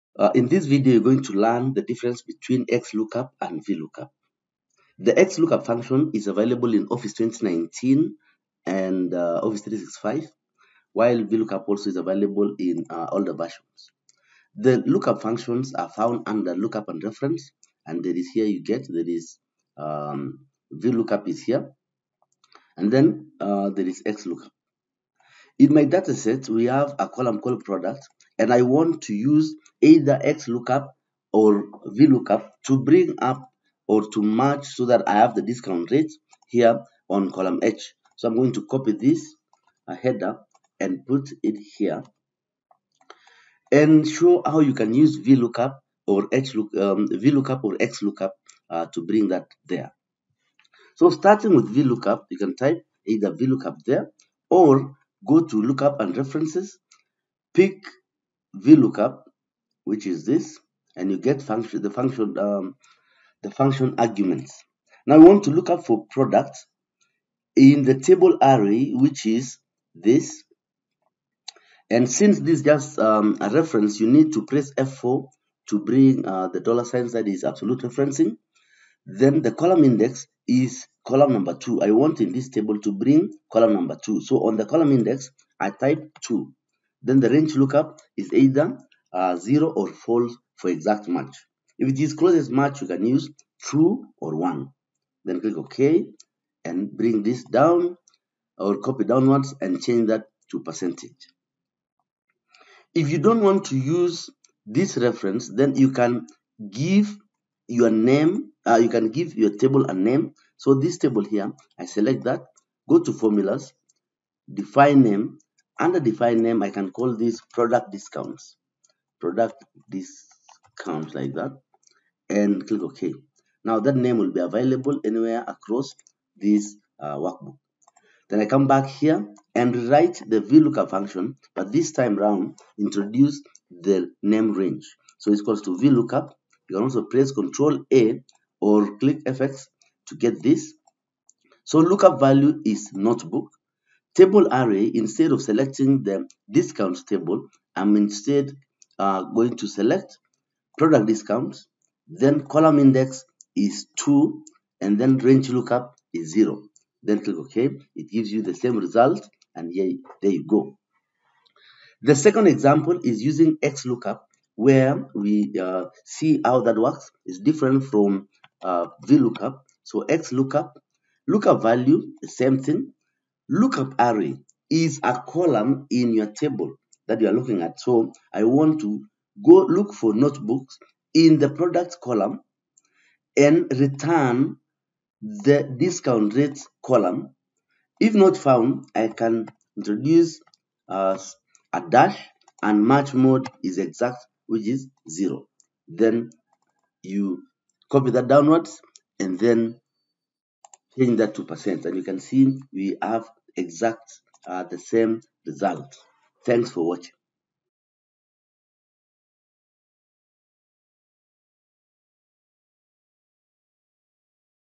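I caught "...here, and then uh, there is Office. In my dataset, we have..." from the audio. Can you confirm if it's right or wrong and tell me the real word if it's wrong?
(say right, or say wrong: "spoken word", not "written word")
wrong: "XLOOKUP", not "Office".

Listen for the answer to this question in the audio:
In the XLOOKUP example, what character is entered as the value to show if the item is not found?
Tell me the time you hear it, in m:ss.
3:11.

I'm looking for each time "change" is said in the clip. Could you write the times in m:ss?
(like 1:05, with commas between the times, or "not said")
1:39, 3:20.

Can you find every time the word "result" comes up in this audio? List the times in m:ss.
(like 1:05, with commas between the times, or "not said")
2:38, 3:25.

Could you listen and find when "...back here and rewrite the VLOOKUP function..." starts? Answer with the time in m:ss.
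2:08.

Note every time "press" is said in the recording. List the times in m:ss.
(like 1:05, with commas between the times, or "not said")
1:14, 2:17.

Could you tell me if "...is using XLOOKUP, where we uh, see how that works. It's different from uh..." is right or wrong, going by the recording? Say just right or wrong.
right.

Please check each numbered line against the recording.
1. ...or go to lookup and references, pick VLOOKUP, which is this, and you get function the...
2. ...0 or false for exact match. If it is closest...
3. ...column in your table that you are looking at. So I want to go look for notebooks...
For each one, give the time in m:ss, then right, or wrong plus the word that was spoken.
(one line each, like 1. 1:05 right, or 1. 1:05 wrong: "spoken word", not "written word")
1. 0:54 right
2. 1:29 right
3. 2:55 right.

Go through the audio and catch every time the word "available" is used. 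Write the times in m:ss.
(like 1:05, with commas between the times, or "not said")
0:06, 0:11, 2:04.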